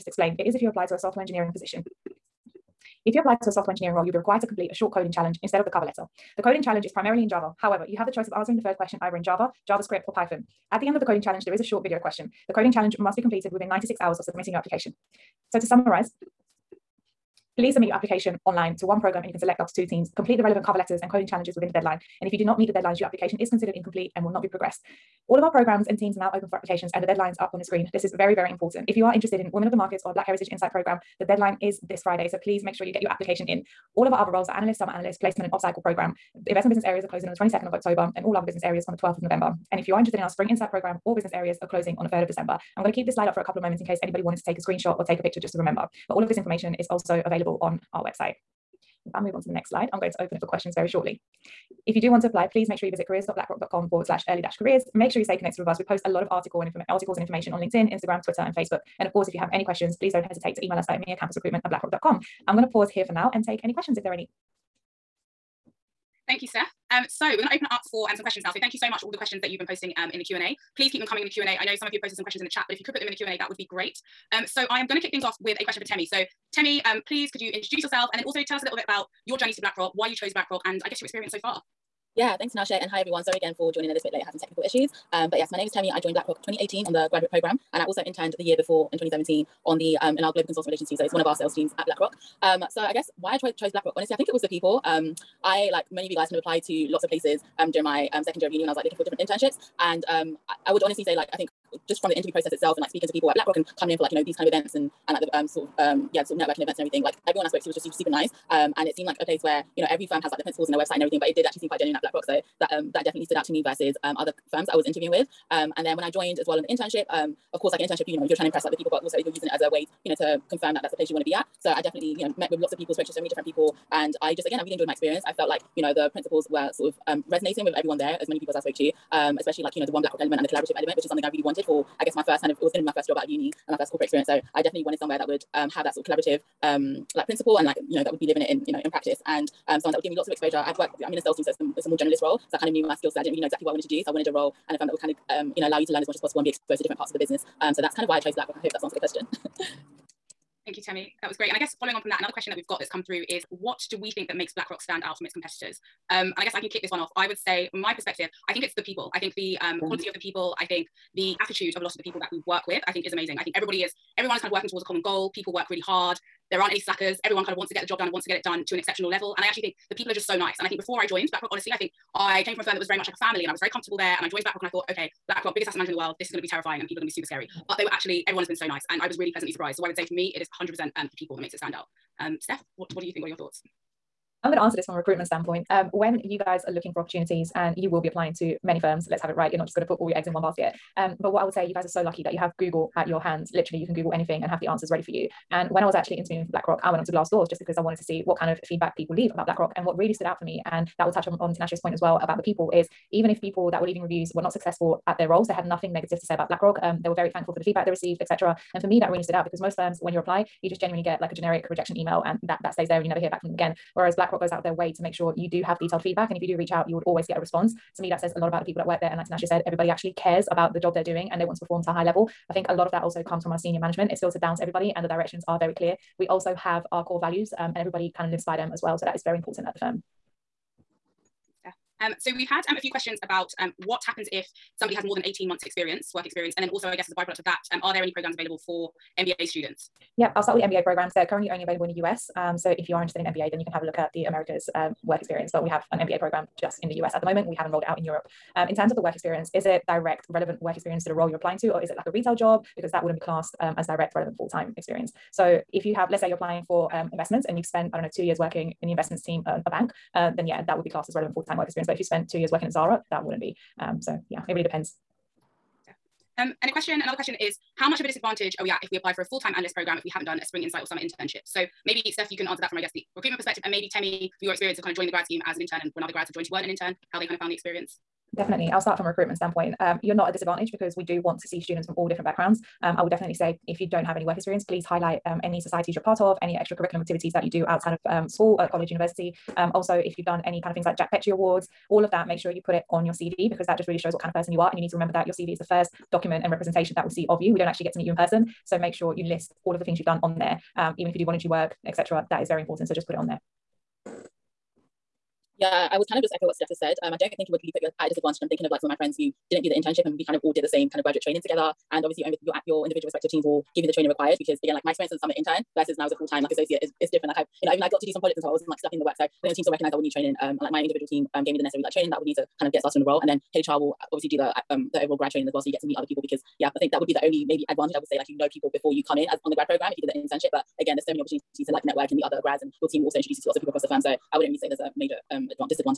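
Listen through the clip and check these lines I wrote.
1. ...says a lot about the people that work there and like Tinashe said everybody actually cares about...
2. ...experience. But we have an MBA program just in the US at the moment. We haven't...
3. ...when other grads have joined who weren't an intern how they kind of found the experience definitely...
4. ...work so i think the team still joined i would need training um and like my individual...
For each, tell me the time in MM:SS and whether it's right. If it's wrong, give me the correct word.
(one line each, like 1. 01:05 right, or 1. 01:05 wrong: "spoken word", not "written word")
1. 03:38 right
2. 04:05 right
3. 04:35 right
4. 05:19 wrong: "recognized", not "joined".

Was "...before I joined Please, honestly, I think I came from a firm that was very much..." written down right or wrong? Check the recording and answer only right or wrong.
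wrong.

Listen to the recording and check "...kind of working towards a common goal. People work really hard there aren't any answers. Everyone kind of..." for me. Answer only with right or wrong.
wrong.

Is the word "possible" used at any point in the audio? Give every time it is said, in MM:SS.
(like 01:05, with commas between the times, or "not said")
02:26.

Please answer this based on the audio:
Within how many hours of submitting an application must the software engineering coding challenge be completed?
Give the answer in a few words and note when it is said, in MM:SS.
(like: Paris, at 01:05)
96, at 00:13.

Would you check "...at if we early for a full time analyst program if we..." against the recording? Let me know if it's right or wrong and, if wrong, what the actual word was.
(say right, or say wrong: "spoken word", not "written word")
wrong: "apply", not "early".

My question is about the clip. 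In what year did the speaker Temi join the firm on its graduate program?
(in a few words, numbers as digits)
2018.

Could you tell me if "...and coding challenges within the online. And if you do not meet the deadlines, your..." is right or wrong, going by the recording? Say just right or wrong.
wrong.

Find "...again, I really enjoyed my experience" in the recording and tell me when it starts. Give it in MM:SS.
02:04.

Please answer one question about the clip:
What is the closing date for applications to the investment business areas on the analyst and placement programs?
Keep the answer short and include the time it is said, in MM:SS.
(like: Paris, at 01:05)
22nd of October, at 00:37.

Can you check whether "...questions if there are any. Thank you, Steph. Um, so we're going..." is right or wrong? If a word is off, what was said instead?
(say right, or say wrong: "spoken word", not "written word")
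right.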